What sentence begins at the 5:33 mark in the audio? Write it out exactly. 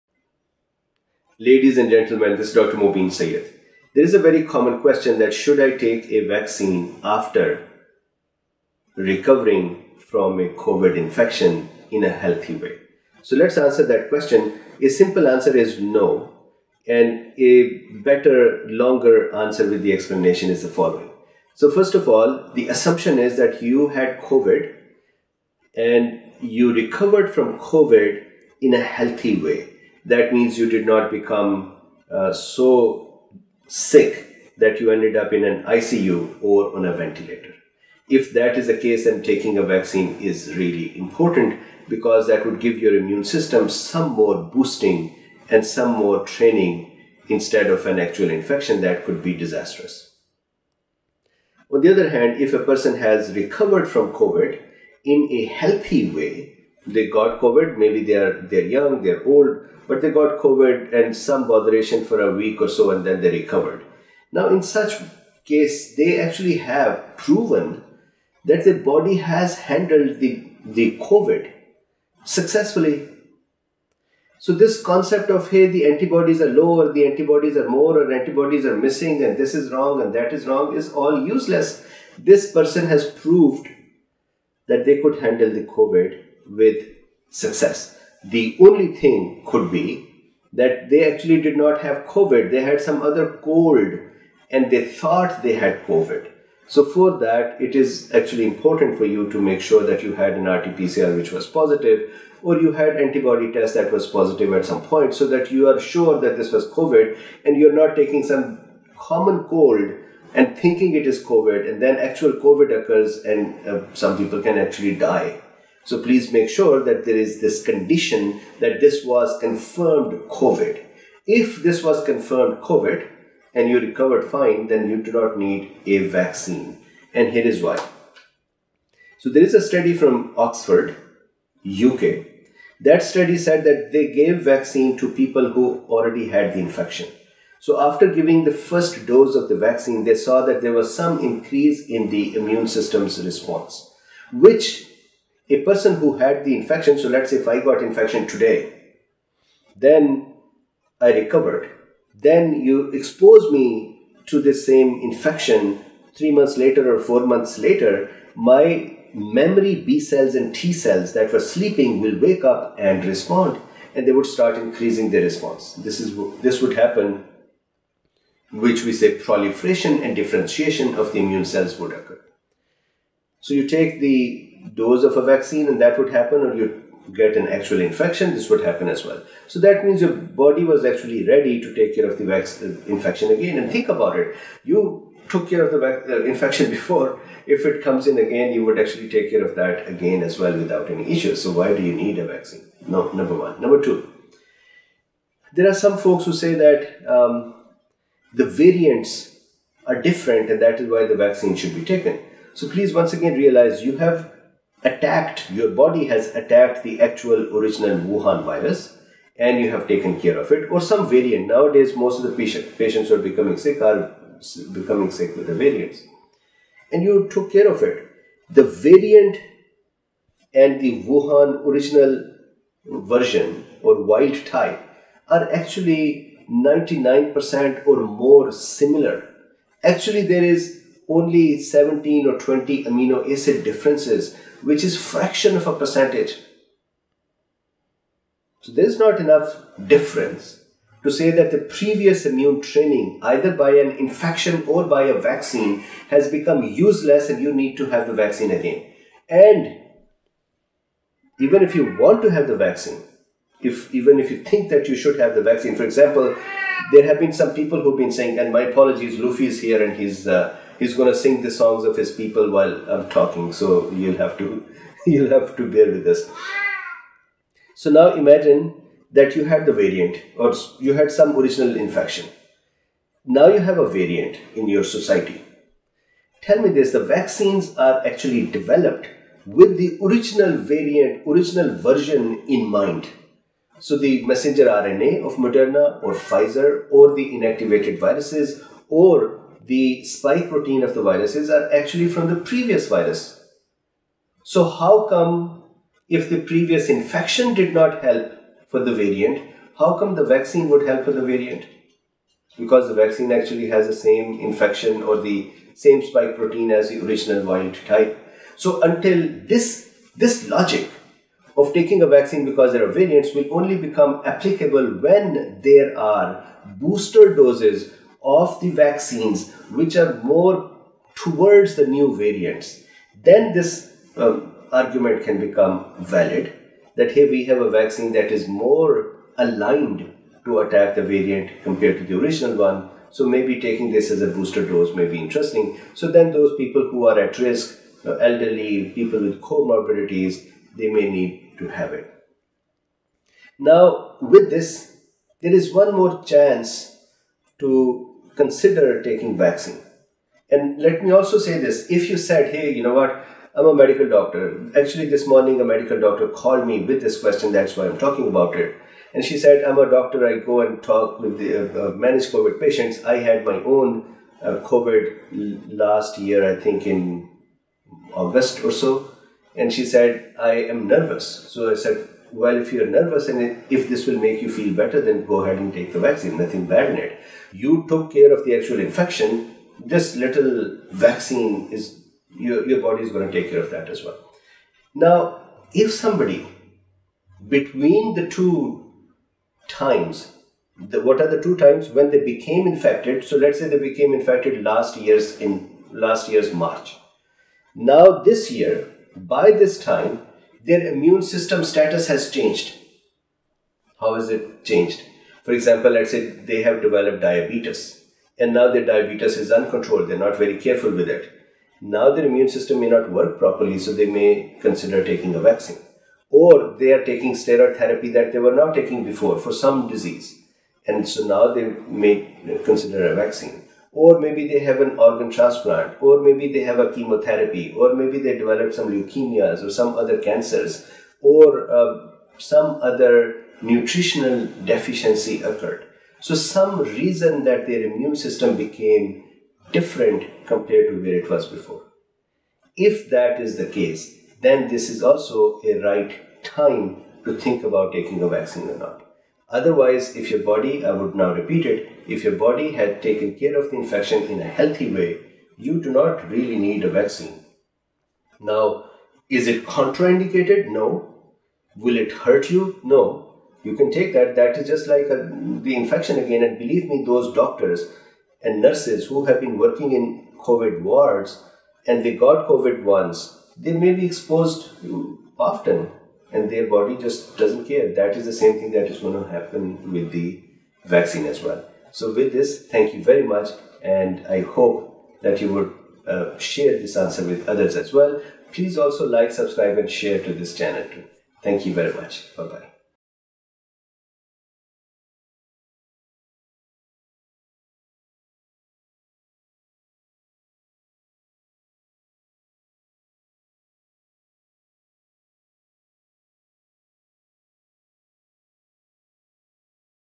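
So maybe taking this as a booster dose may be interesting.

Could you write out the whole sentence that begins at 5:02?
Because the vaccine actually has the same infection or the same spike protein as the original wild type.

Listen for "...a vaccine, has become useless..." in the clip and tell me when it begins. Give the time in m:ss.
4:05.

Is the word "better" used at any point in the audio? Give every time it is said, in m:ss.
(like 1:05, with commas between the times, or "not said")
0:18, 6:14.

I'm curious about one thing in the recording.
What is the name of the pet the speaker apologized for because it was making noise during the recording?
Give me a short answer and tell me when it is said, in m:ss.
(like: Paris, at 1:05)
Luffy, at 4:19.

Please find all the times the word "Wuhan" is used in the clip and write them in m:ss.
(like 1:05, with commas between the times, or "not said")
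3:27, 3:41.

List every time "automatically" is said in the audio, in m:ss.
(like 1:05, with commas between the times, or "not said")
not said.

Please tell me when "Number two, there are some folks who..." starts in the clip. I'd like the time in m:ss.
3:13.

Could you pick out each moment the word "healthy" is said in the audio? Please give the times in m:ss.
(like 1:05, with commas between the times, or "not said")
0:12, 0:28, 0:55, 7:34.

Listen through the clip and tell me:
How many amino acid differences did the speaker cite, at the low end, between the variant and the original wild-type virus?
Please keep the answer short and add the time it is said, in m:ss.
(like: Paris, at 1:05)
17, at 3:51.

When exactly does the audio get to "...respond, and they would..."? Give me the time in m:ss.
2:43.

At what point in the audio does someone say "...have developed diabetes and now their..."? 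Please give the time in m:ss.
6:46.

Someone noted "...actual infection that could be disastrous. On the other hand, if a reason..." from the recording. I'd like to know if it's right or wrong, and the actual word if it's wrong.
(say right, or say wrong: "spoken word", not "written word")
wrong: "person", not "reason".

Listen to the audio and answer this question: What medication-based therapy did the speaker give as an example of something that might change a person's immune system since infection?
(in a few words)
Steroid therapy.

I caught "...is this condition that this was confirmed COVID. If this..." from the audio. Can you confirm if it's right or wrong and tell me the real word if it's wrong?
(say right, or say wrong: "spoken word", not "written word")
right.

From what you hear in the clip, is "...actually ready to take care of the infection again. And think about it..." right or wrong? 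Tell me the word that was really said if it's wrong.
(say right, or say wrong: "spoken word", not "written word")
right.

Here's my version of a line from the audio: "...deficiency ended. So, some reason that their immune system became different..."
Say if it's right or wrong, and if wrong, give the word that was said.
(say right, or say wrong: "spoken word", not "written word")
wrong: "occurred", not "ended".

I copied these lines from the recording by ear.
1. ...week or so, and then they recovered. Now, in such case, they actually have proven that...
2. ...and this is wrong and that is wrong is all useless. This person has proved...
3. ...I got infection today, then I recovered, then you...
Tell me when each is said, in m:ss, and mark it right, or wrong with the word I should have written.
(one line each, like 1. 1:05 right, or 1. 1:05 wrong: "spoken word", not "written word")
1. 1:02 right
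2. 1:19 right
3. 2:27 right.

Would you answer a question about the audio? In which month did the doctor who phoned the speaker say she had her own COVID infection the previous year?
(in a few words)
August.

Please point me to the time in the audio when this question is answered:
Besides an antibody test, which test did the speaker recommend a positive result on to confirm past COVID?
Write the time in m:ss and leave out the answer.
1:40.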